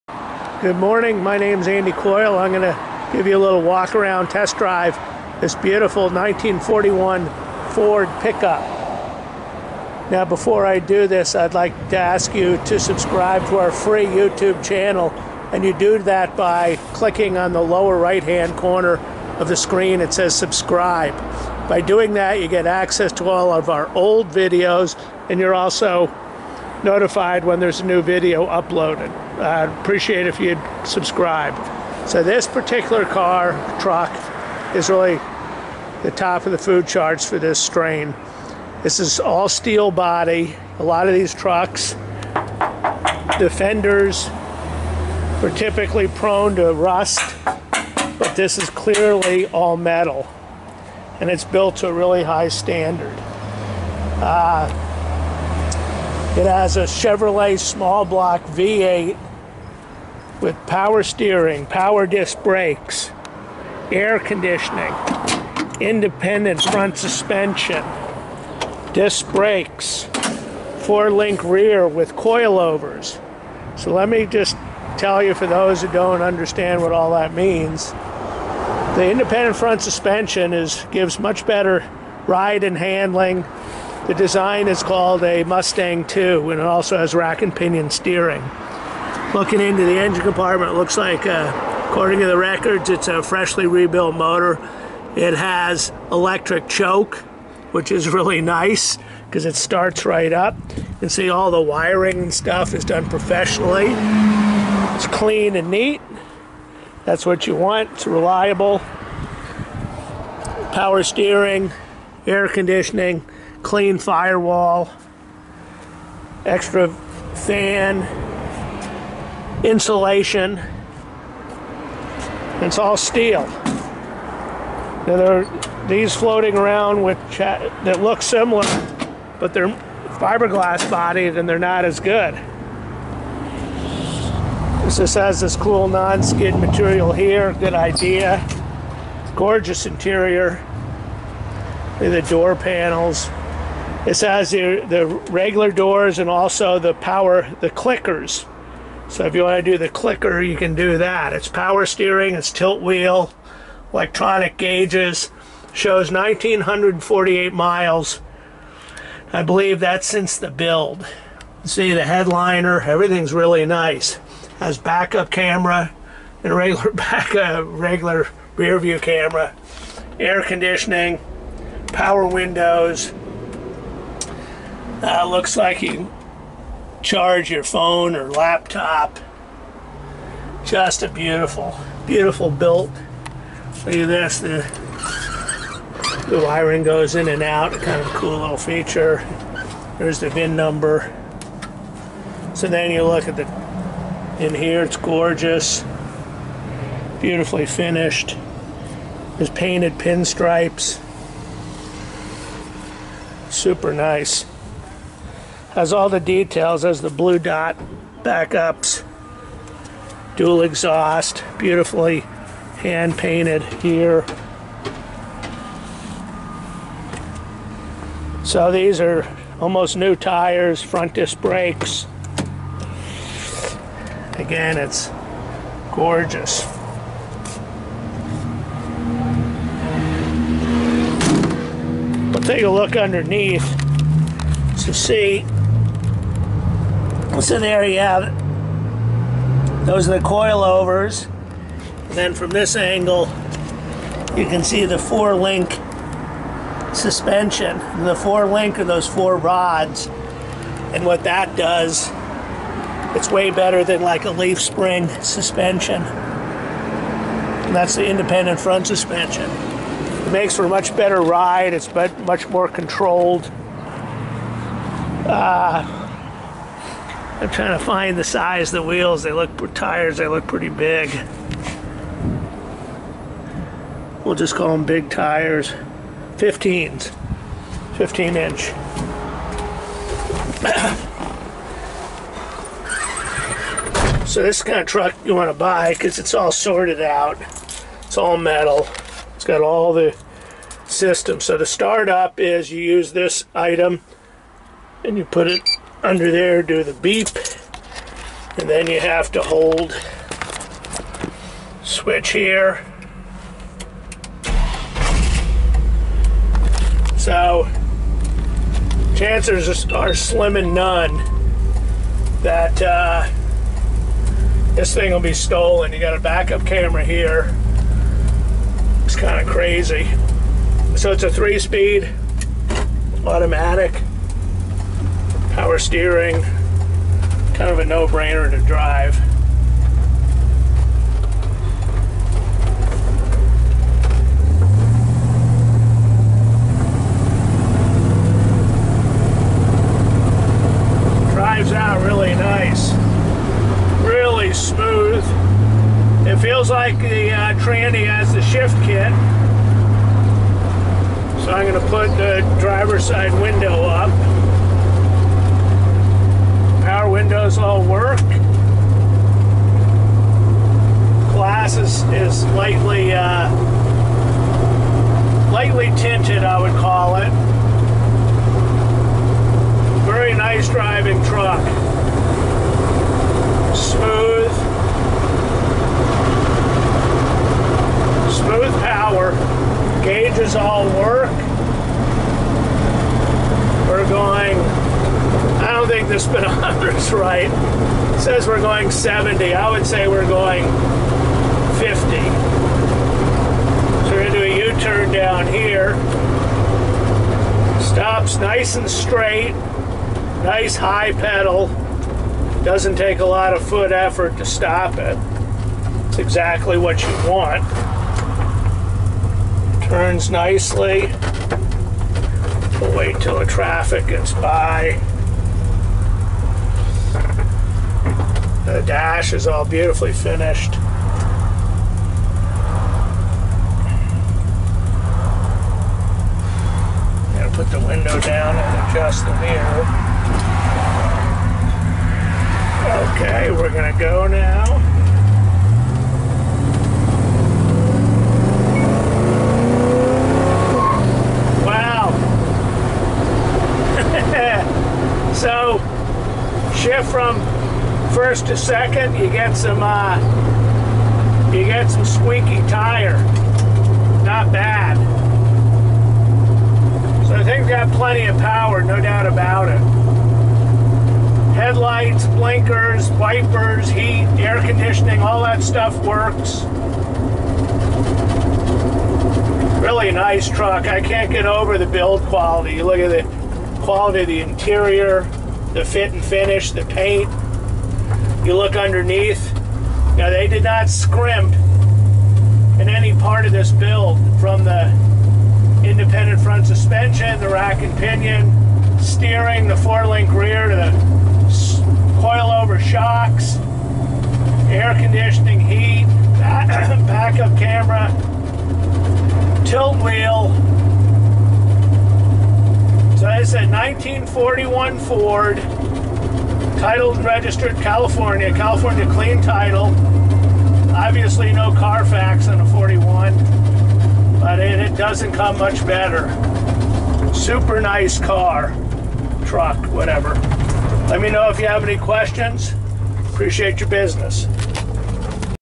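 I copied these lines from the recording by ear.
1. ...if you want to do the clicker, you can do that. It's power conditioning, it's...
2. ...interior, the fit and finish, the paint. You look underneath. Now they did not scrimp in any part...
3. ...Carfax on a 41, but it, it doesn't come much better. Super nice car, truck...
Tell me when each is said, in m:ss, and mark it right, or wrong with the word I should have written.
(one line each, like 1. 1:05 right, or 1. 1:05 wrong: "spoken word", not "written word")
1. 2:29 wrong: "steering", not "conditioning"
2. 7:54 right
3. 8:31 right.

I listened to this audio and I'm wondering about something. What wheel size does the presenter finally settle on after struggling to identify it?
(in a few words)
15 inch.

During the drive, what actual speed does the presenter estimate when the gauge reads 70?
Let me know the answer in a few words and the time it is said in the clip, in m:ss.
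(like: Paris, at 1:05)
50, at 6:31.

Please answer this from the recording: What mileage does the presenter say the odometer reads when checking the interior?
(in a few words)
1,948 miles.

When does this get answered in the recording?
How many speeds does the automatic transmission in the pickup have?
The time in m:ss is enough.
5:21.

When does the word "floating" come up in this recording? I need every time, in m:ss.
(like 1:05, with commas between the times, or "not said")
2:06.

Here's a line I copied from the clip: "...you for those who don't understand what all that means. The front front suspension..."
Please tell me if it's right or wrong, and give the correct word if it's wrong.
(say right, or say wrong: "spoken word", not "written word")
wrong: "independent", not "front".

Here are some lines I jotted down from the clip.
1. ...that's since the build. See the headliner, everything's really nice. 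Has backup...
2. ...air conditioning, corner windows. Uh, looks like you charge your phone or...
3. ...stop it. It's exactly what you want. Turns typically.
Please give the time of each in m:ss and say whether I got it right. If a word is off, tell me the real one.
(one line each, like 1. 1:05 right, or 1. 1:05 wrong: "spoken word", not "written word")
1. 2:39 right
2. 2:50 wrong: "power", not "corner"
3. 6:44 wrong: "nicely", not "typically".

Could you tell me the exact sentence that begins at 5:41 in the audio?
Drives out really nice, really smooth.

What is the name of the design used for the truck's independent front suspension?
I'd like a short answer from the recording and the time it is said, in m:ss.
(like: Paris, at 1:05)
Mustang 2, at 1:25.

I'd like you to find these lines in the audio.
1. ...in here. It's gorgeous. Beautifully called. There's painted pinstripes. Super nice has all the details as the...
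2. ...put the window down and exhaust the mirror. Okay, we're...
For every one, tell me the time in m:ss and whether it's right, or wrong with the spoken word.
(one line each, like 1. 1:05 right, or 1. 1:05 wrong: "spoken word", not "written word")
1. 3:14 wrong: "finished", not "called"
2. 7:07 wrong: "adjust", not "exhaust".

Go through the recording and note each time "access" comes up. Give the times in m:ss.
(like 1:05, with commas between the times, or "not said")
0:22.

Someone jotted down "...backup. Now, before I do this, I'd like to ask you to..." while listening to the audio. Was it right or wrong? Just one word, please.
wrong.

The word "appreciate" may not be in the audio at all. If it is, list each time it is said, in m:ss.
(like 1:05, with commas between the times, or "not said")
0:29, 8:43.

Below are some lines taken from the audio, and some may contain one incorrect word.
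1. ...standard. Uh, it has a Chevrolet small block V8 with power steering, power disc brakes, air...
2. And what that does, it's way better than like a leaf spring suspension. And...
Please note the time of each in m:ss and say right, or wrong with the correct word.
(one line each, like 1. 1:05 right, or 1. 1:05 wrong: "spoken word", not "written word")
1. 0:52 right
2. 4:10 right.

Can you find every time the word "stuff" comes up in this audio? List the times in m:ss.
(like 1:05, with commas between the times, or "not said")
1:42, 7:45.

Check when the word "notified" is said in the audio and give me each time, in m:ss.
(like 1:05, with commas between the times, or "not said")
0:26.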